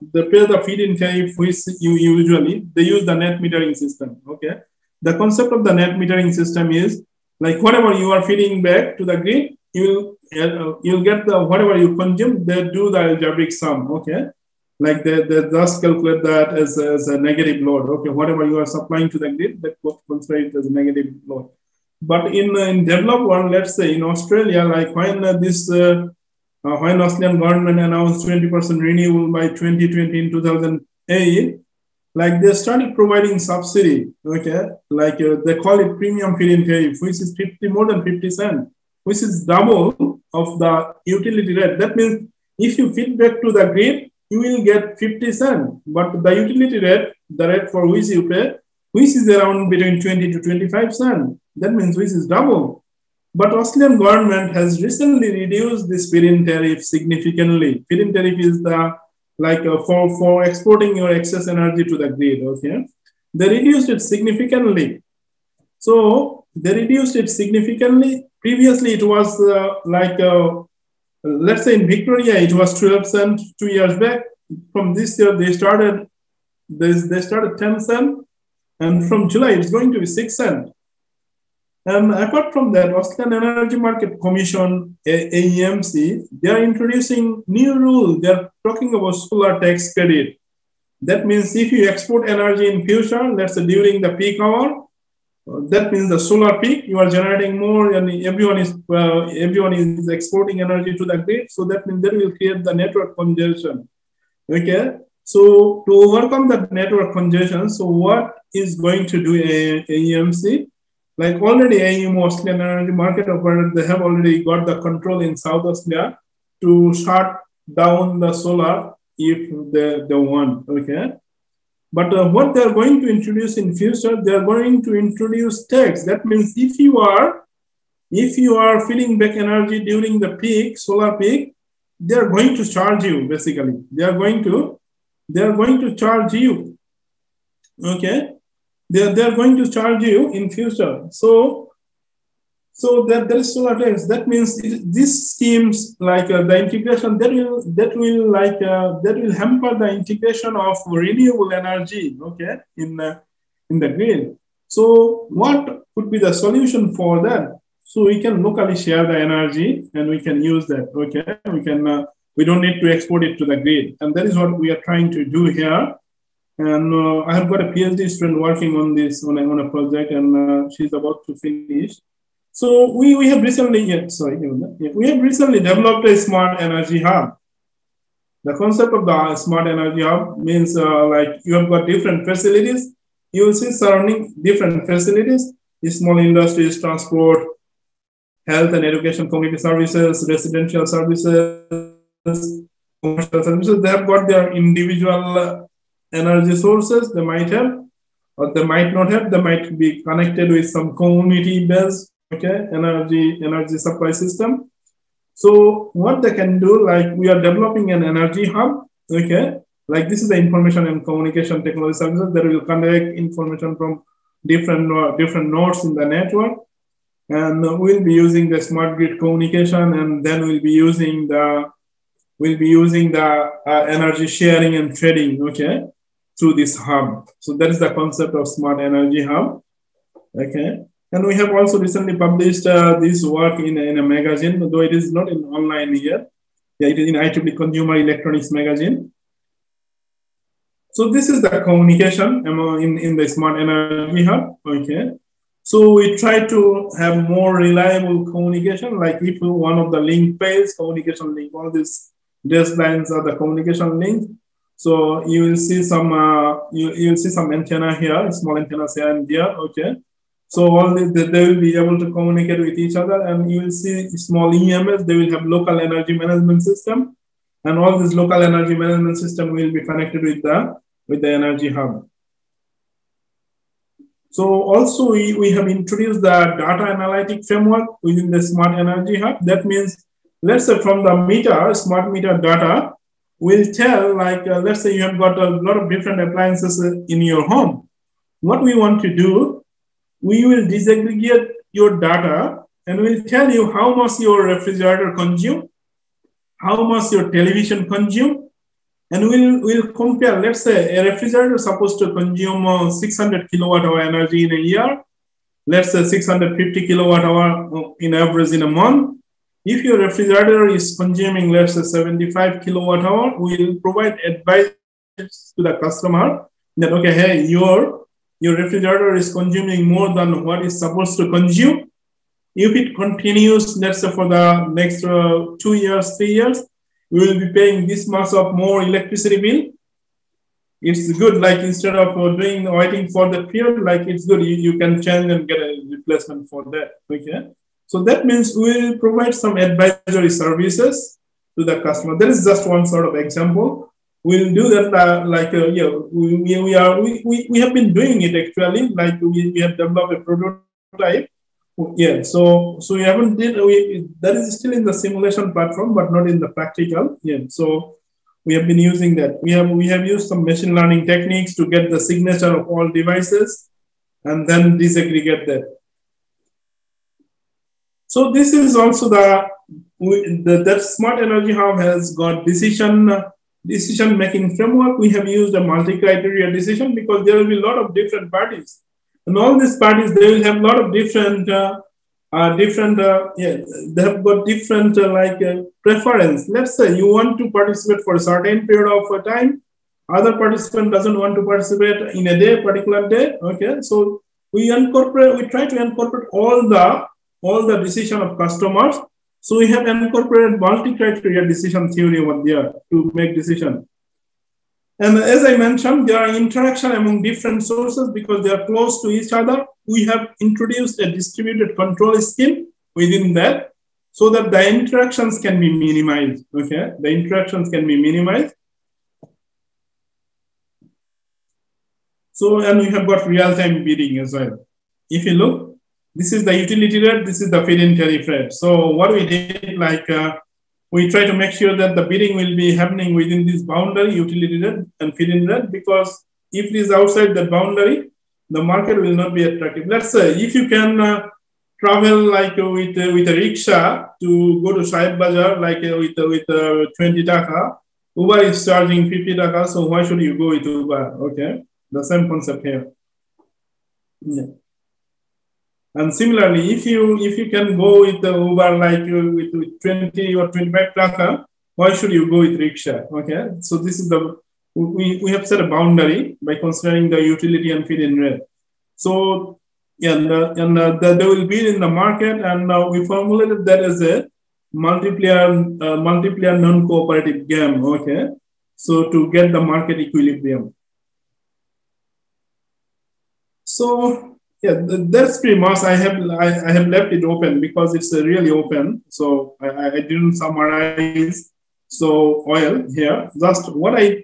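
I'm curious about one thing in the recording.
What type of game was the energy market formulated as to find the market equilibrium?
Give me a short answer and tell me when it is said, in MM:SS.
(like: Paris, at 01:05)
Multiplayer non-cooperative game, at 07:56.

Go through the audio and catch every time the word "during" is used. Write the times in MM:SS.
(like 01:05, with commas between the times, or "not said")
01:33, 02:09.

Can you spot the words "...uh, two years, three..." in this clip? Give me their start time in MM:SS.
05:25.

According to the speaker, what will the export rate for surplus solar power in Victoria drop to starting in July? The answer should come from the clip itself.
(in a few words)
6 cents.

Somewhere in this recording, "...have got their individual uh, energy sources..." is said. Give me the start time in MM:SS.
03:13.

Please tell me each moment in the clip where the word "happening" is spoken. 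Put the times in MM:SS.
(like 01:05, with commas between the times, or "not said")
07:12.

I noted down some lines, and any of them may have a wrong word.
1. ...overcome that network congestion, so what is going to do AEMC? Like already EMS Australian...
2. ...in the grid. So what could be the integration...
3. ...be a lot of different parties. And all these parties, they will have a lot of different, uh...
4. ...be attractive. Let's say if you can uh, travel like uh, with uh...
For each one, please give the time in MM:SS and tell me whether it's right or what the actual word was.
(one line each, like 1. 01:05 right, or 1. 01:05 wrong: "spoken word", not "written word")
1. 01:46 wrong: "AEM", not "EMS"
2. 02:33 wrong: "solution", not "integration"
3. 06:17 right
4. 07:19 right.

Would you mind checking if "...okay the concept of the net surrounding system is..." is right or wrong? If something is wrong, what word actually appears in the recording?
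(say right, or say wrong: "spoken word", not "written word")
wrong: "metering", not "surrounding".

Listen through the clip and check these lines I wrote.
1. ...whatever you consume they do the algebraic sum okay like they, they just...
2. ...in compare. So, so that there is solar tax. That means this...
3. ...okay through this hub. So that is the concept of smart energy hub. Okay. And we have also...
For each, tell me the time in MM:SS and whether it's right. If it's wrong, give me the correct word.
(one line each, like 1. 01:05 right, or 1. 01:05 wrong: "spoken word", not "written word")
1. 00:11 right
2. 02:20 wrong: "future", not "compare"
3. 03:45 right.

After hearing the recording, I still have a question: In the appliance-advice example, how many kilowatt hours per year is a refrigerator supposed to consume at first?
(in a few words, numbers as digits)
600 kWh.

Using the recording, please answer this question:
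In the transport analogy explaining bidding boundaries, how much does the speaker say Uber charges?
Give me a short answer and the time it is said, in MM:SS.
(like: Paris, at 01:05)
50 taka, at 07:29.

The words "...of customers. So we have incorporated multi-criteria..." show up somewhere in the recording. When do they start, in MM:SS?
06:38.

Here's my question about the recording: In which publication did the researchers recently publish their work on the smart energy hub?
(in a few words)
IEEE Consumer Electronics Magazine.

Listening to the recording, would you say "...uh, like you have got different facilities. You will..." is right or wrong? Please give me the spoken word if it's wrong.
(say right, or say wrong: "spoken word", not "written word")
right.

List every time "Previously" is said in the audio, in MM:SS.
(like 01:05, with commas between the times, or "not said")
01:08.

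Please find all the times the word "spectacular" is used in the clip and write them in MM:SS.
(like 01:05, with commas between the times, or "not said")
not said.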